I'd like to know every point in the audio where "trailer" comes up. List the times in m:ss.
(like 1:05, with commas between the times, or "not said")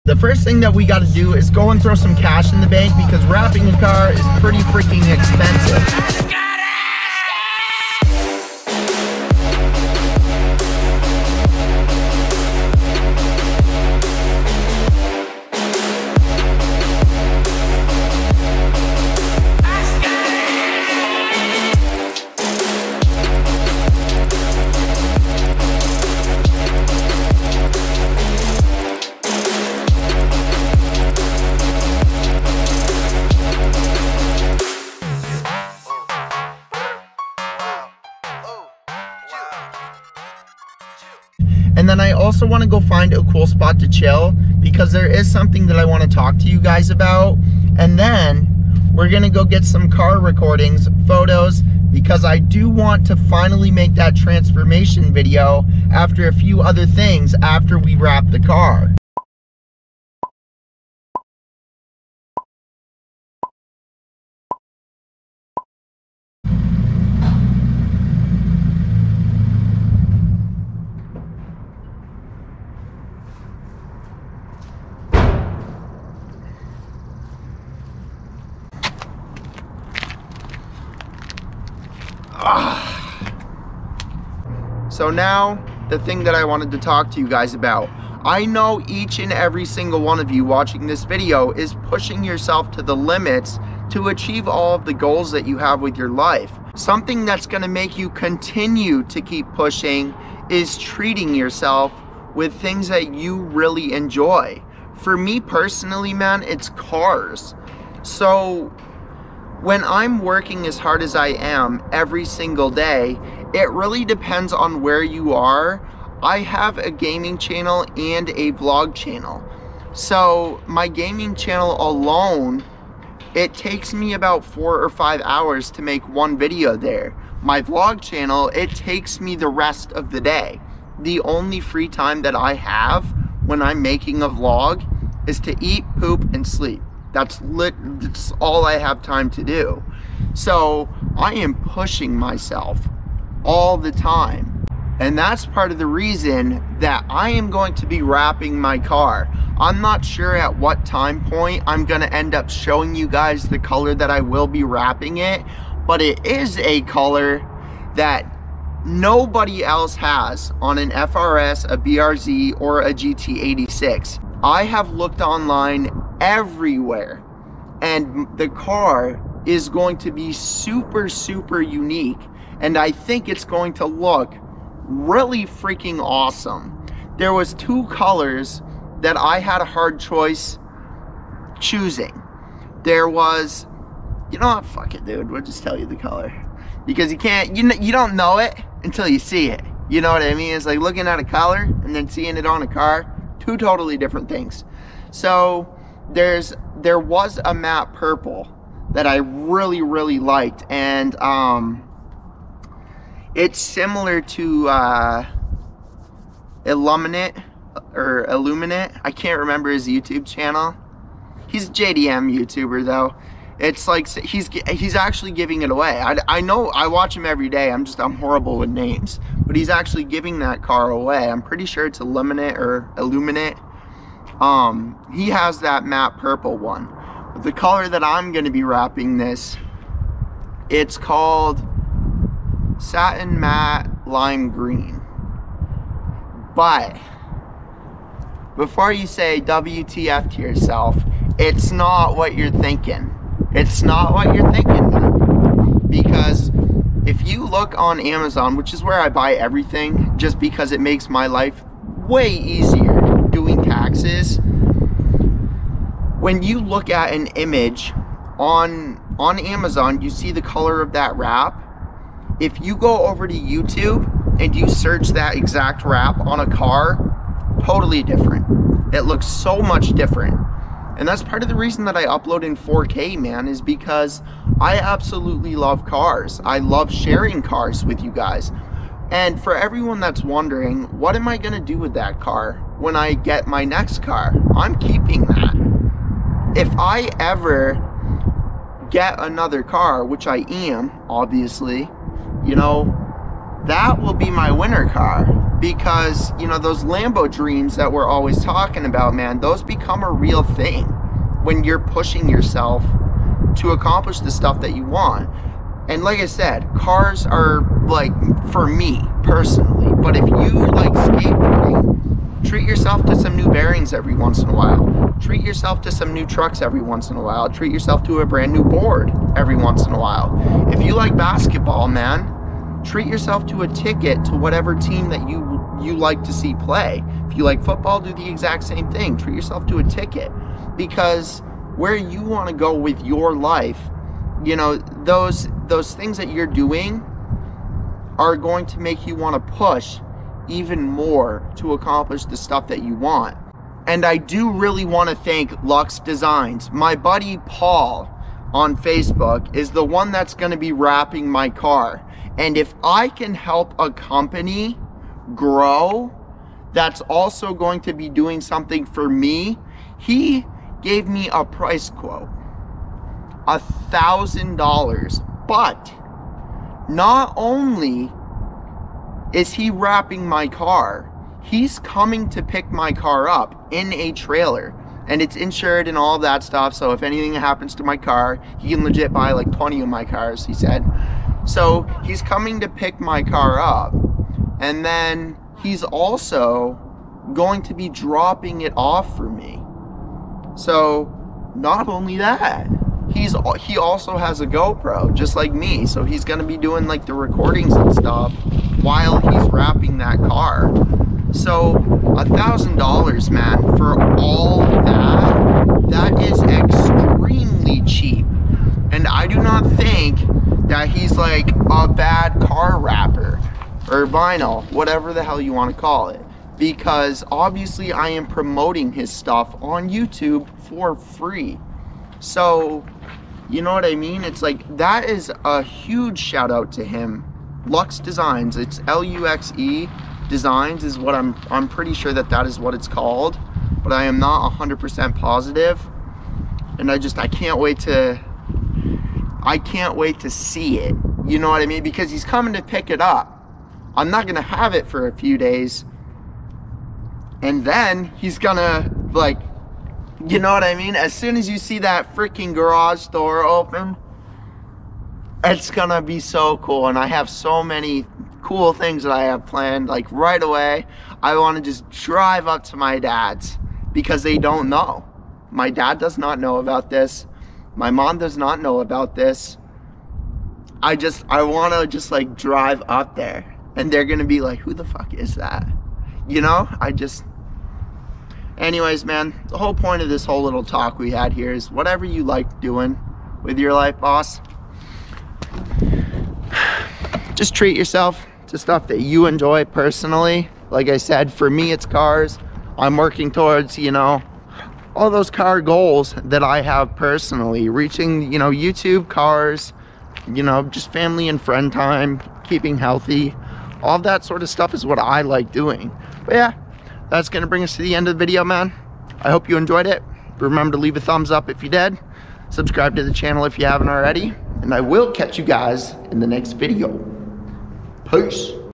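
6:14.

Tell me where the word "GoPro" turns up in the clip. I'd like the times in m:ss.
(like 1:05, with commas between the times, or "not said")
6:34.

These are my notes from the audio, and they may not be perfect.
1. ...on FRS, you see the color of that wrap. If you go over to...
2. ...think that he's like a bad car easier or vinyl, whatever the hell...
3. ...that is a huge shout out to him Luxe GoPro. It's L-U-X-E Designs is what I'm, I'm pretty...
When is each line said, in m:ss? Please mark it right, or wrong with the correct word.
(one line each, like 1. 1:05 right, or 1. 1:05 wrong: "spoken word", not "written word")
1. 4:19 wrong: "Amazon", not "FRS"
2. 6:49 wrong: "wrapper", not "easier"
3. 7:04 wrong: "Designs", not "GoPro".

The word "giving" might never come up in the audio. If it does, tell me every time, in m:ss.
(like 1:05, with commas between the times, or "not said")
3:35, 3:40.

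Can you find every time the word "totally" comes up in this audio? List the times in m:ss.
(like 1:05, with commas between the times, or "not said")
3:13, 4:27.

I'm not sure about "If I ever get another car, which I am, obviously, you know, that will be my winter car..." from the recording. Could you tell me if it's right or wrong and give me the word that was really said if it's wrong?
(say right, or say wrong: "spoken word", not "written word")
right.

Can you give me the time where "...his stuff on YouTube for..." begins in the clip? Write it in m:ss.
6:58.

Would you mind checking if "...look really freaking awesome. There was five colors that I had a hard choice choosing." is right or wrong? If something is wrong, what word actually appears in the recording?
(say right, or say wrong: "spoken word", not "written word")
wrong: "two", not "five".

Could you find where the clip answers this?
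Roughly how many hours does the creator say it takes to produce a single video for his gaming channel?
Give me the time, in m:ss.
2:04.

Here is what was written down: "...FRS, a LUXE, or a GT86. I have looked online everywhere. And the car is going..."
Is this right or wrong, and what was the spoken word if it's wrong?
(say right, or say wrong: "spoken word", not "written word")
wrong: "BRZ", not "LUXE".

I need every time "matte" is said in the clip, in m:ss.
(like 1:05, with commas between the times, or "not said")
3:17, 3:45, 3:53.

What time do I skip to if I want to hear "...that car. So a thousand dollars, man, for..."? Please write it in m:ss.
6:39.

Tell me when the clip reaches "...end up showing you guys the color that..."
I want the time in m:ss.
2:32.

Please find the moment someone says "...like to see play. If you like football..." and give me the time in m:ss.
5:25.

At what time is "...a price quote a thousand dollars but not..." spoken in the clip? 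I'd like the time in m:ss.
6:01.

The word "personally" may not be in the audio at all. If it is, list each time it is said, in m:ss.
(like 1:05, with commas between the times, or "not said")
1:45, 5:09, 8:09, 8:16.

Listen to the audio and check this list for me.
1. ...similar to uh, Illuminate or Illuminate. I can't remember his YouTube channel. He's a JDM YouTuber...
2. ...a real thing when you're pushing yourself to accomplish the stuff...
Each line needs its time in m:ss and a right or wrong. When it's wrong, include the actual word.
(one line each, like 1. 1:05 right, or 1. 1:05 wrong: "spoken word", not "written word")
1. 3:23 right
2. 5:00 right.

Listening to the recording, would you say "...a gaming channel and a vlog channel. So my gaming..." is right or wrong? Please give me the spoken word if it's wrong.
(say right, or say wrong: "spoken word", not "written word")
right.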